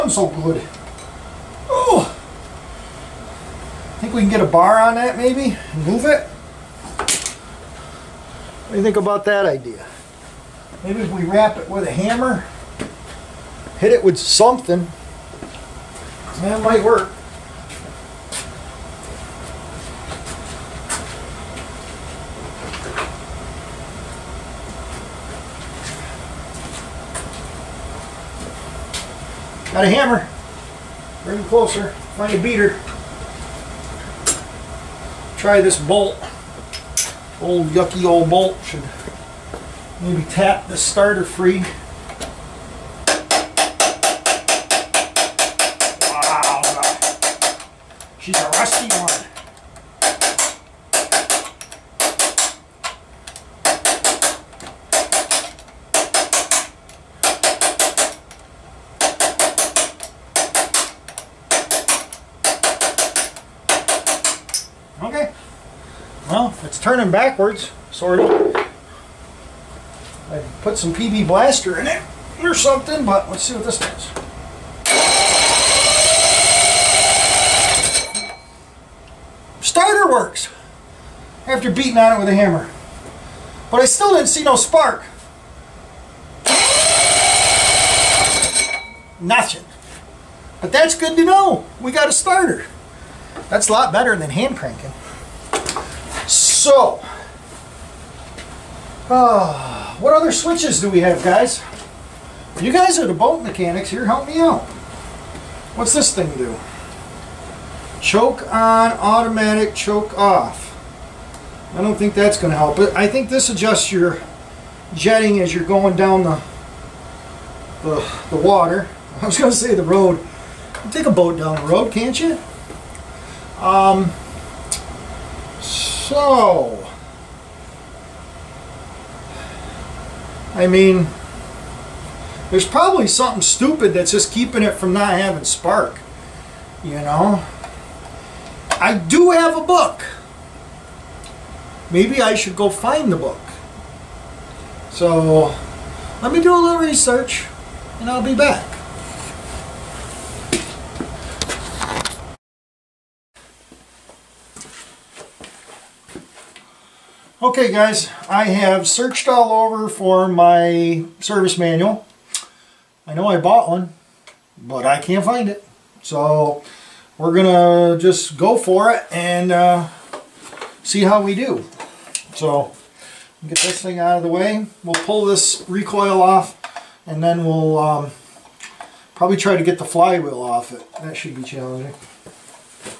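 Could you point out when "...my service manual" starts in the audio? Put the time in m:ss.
2:40.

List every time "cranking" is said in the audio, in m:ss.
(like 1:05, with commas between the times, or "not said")
1:34.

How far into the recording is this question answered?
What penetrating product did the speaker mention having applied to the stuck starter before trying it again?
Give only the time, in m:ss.
1:10.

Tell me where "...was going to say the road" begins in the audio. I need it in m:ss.
1:59.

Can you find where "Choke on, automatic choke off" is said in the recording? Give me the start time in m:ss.
1:48.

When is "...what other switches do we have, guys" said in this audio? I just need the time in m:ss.
1:39.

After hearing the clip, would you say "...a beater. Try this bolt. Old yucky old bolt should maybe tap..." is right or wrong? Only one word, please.
right.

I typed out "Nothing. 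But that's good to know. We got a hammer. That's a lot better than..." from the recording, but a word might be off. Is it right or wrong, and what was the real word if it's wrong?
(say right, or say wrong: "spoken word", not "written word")
wrong: "starter", not "hammer".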